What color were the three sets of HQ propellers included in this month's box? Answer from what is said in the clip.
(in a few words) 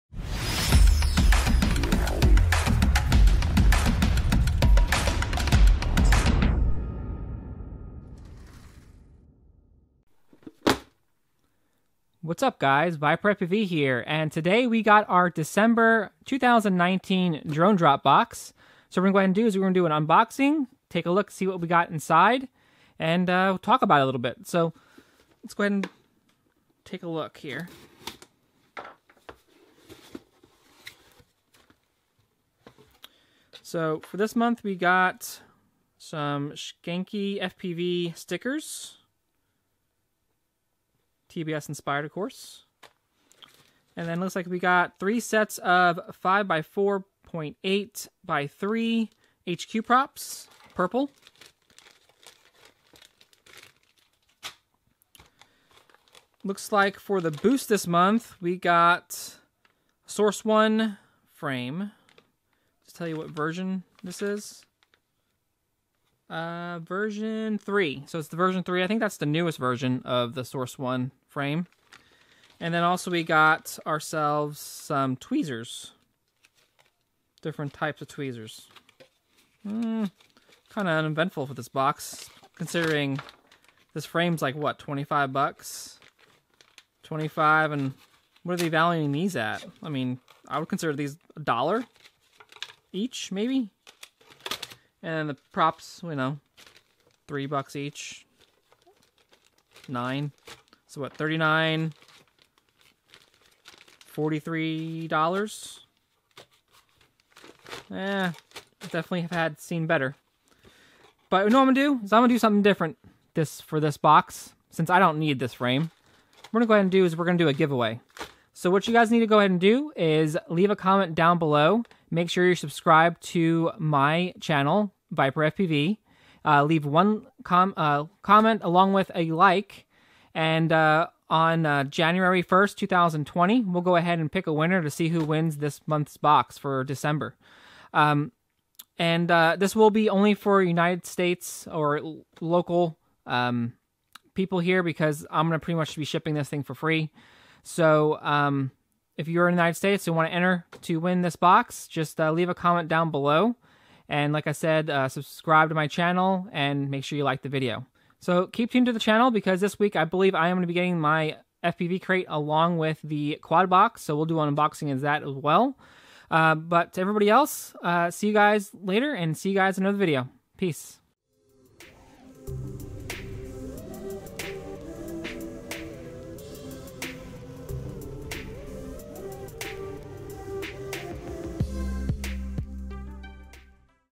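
Purple.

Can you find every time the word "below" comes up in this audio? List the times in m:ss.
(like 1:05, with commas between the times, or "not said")
2:01, 2:33.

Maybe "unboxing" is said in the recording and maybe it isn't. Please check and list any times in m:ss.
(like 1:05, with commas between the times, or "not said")
0:20, 2:44.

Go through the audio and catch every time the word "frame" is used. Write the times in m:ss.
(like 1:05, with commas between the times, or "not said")
1:01, 1:11, 1:24, 1:55.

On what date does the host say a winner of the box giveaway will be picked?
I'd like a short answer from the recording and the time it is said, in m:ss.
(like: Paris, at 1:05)
January 1st, 2020, at 2:11.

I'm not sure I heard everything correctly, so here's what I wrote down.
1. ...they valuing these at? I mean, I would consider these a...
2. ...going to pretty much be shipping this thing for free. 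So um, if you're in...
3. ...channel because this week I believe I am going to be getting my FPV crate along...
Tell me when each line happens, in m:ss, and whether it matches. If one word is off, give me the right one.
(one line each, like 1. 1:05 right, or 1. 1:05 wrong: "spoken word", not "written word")
1. 1:28 right
2. 2:25 right
3. 2:38 right.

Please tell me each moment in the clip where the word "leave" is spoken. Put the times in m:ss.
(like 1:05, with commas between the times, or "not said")
2:00, 2:06, 2:32.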